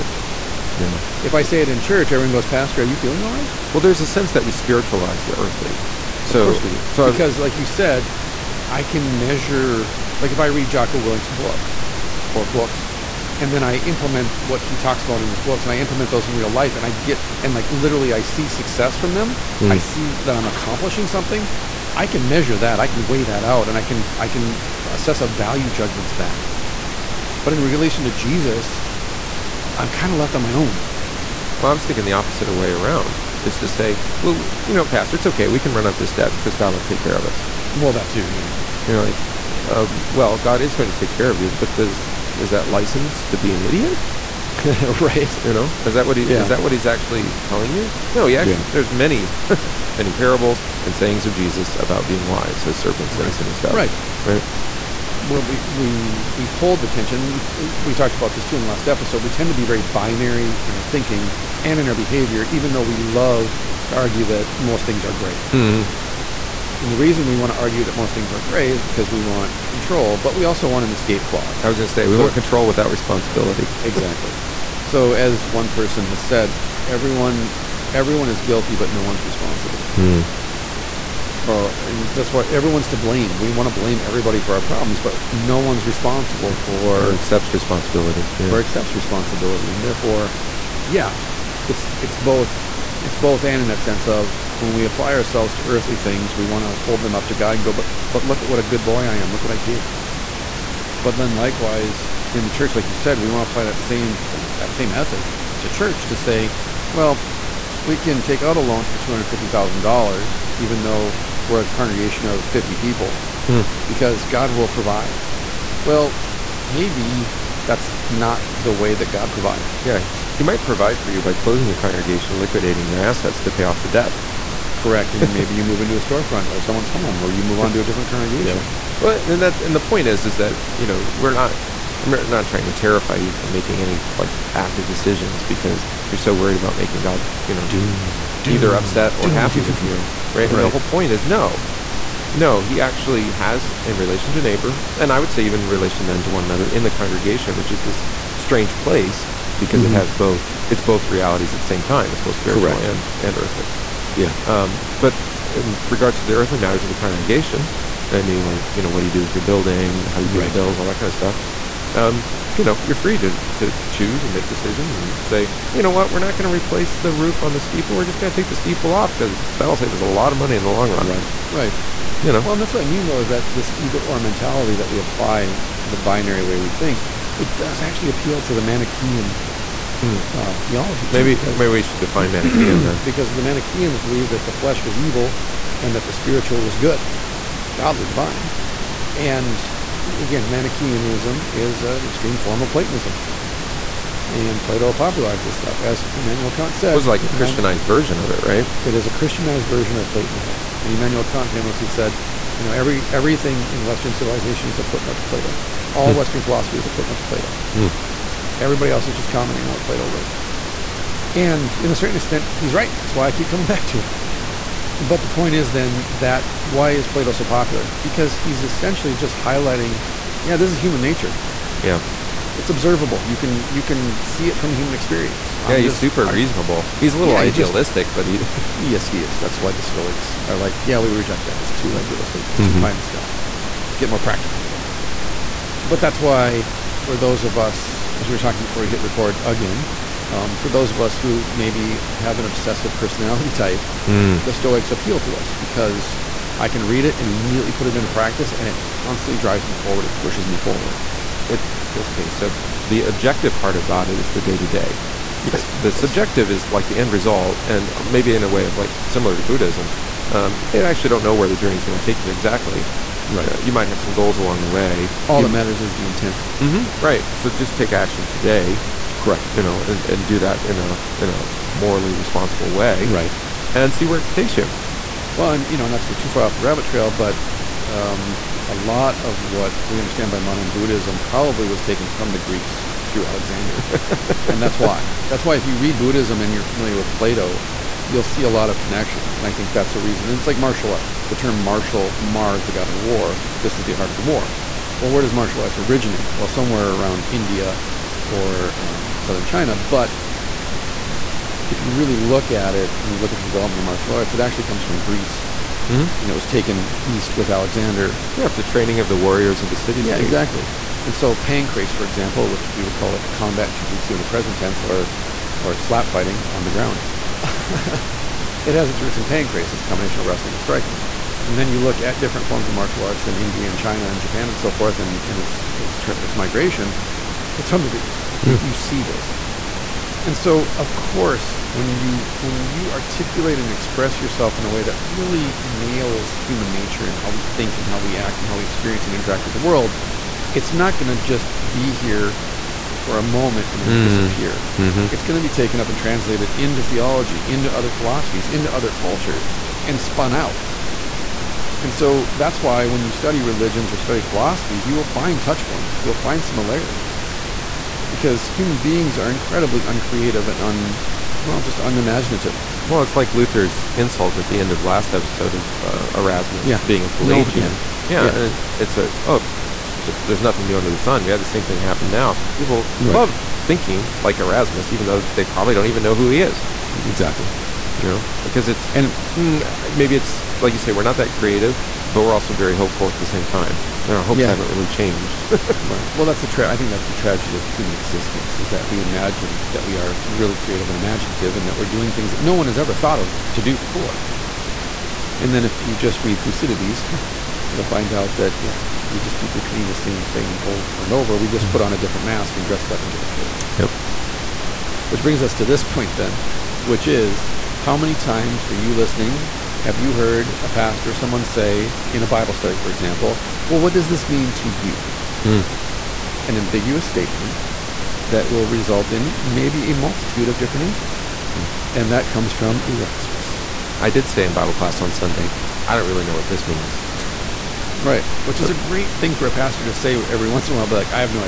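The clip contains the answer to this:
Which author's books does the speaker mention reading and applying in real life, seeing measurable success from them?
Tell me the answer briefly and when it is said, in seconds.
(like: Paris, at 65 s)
Jocko Willink, at 10 s.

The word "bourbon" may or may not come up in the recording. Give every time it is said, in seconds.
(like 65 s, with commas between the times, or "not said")
not said.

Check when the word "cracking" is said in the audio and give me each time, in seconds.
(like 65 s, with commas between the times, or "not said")
not said.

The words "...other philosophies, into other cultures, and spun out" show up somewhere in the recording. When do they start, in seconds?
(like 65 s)
347 s.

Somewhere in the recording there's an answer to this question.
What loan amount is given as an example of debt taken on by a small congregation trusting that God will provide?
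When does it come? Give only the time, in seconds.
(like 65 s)
108 s.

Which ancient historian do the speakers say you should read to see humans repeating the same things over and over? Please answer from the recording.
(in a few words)
Thucydides.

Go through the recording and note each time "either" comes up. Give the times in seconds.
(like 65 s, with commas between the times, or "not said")
138 s, 173 s.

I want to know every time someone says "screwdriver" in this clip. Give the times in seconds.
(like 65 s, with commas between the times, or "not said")
not said.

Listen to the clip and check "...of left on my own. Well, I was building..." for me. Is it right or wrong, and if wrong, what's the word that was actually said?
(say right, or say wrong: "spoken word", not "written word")
wrong: "thinking", not "building".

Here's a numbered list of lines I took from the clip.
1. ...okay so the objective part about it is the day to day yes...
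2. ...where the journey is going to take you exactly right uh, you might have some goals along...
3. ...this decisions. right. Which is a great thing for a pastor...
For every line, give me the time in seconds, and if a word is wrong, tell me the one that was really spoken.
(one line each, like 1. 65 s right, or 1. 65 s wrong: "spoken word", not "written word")
1. 251 s right
2. 261 s right
3. 426 s wrong: "means", not "decisions".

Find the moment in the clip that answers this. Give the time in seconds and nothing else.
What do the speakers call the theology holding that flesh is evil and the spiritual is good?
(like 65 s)
190 s.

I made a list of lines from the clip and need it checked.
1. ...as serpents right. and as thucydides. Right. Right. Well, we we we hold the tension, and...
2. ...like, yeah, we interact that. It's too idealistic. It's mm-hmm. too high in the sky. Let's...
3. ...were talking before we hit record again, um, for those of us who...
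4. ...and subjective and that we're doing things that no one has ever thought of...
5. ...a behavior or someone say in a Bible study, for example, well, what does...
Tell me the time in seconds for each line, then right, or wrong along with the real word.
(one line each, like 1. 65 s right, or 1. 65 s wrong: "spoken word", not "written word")
1. 52 s wrong: "doves", not "thucydides"
2. 230 s wrong: "reject", not "interact"
3. 238 s right
4. 390 s wrong: "imaginative", not "subjective"
5. 410 s wrong: "pastor", not "behavior".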